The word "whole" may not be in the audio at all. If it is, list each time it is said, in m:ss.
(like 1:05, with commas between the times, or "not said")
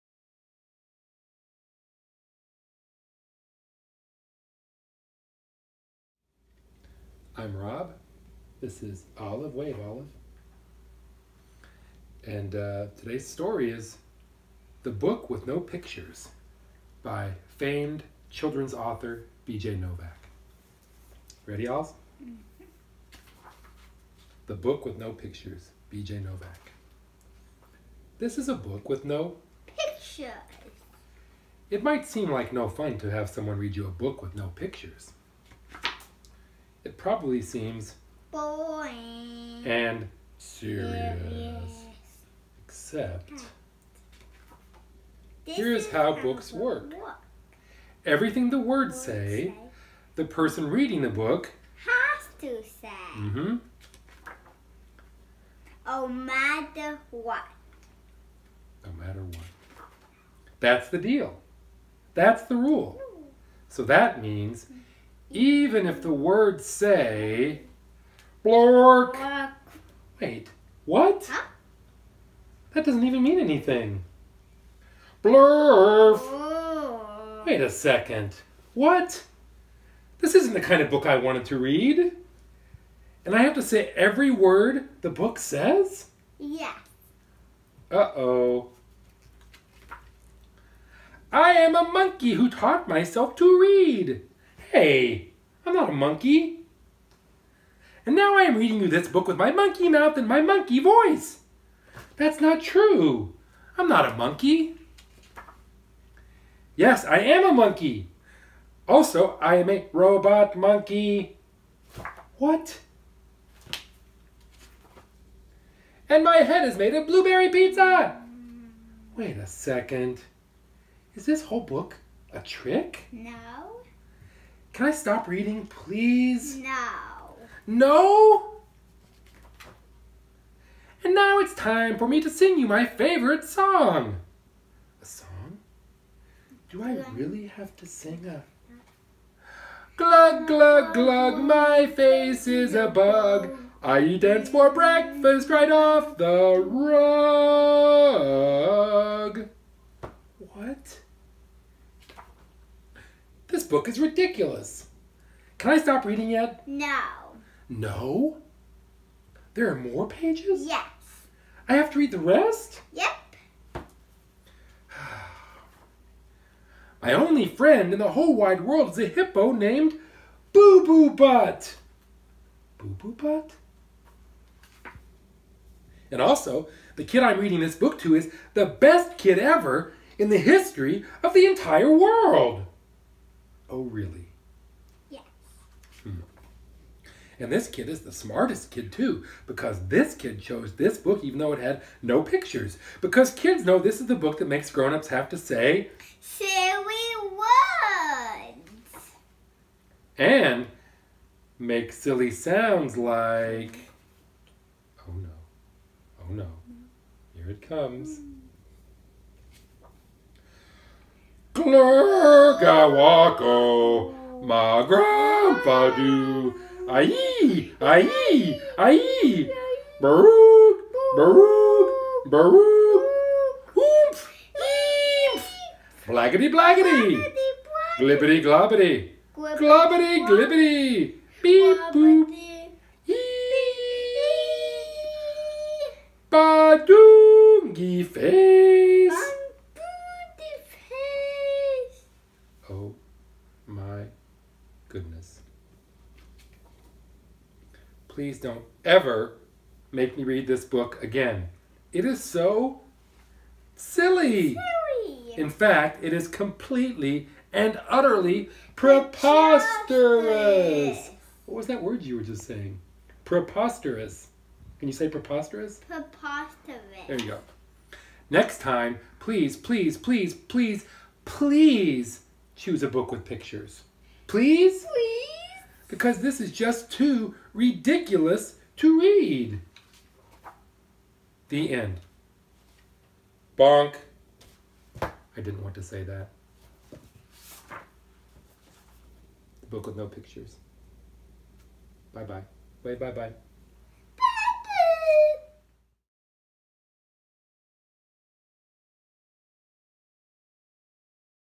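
2:01, 2:48.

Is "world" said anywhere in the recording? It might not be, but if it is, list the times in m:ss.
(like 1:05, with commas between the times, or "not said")
2:48, 3:01.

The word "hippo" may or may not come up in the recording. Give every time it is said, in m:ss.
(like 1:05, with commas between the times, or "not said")
2:49.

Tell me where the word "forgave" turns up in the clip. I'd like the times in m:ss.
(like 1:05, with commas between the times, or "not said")
not said.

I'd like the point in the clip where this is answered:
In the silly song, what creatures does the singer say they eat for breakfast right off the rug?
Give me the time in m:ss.
2:24.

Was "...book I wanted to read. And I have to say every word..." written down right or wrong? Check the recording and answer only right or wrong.
right.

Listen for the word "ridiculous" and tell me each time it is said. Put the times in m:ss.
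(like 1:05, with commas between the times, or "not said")
2:33, 4:37.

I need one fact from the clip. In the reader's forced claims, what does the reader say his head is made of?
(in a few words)
Blueberry pizza.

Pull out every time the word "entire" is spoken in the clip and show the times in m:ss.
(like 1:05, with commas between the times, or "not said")
3:01.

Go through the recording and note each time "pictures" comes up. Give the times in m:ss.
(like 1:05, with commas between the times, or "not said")
0:15, 0:25, 0:29, 0:34, 3:12, 4:33, 4:50.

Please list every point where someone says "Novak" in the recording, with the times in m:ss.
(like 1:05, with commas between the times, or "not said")
0:19, 0:26.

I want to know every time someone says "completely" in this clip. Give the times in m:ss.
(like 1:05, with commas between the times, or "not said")
4:16.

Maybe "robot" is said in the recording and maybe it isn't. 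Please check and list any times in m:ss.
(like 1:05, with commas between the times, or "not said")
1:49.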